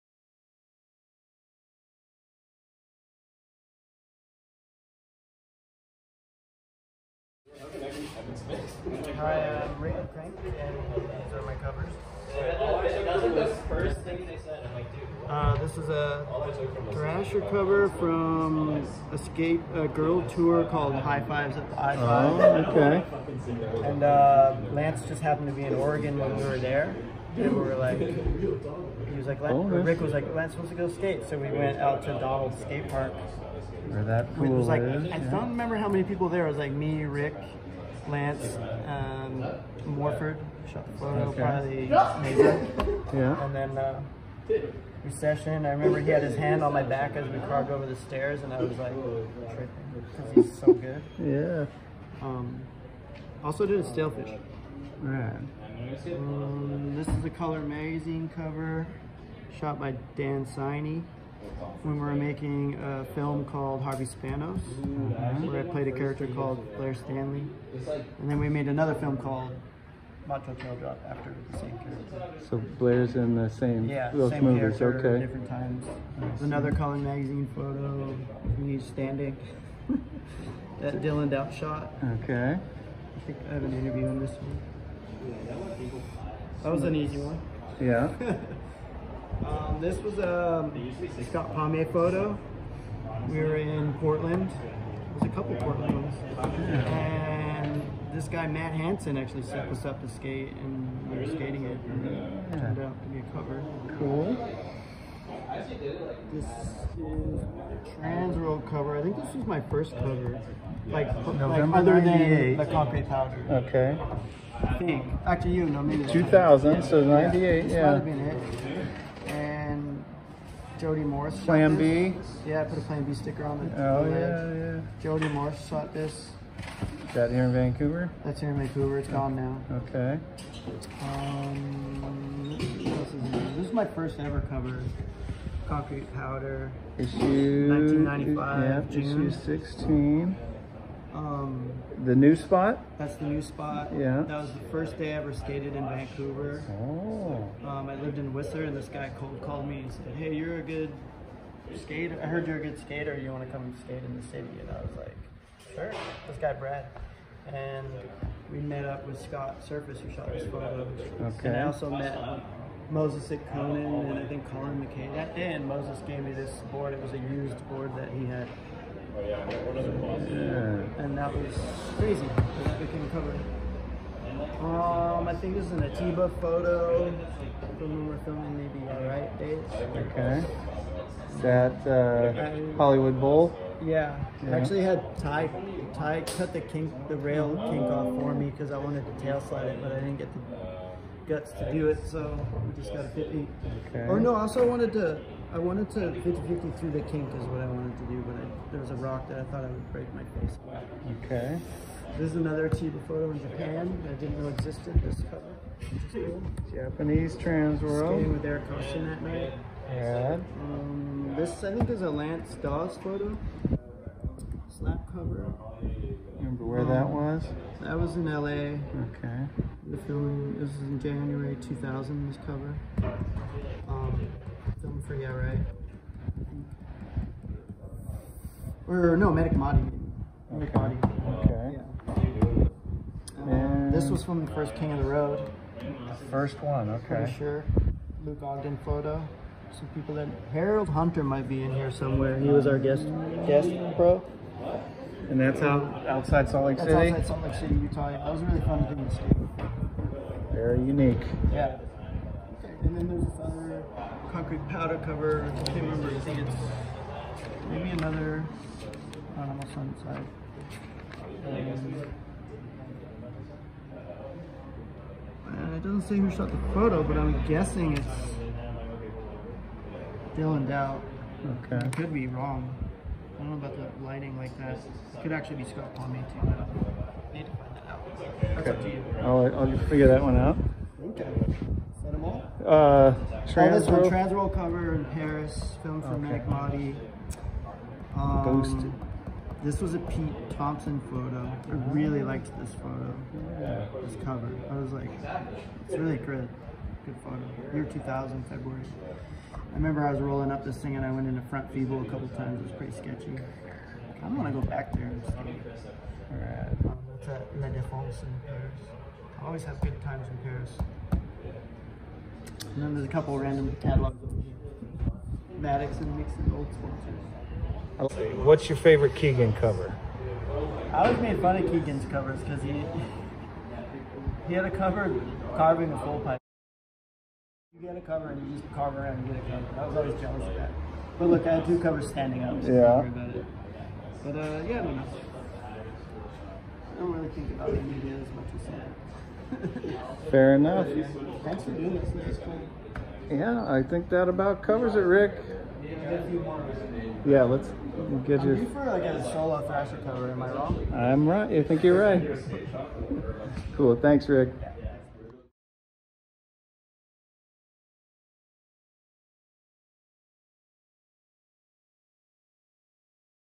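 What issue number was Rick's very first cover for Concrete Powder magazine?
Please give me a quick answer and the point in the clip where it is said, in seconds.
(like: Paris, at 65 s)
16, at 139 s.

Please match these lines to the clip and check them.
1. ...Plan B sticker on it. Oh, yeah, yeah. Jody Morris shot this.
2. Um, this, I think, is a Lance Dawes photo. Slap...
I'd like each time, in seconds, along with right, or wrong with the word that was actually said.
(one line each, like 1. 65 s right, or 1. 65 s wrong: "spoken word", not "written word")
1. 122 s right
2. 210 s right.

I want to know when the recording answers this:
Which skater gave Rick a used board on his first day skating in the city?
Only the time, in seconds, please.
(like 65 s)
162 s.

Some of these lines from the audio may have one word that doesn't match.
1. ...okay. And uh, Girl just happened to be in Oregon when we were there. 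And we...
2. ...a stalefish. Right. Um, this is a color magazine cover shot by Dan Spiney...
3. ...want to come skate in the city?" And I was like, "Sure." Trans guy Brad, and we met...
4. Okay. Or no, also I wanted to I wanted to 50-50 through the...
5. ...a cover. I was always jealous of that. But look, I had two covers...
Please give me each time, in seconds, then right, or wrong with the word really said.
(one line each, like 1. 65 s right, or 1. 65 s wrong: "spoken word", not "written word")
1. 22 s wrong: "Lance", not "Girl"
2. 53 s right
3. 153 s wrong: "This", not "Trans"
4. 193 s right
5. 329 s right.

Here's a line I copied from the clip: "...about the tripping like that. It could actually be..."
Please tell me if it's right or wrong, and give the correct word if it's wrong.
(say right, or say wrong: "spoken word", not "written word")
wrong: "lighting", not "tripping".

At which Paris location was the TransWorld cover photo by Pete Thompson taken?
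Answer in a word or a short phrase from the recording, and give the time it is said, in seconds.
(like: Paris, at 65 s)
La Défense, at 307 s.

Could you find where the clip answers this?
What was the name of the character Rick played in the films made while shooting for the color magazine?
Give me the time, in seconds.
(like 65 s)
66 s.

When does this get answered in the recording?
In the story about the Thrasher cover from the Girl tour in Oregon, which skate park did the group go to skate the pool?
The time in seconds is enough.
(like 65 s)
32 s.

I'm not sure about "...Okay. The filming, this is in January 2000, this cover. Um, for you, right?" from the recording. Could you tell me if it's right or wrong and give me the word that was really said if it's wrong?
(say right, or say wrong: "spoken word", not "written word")
right.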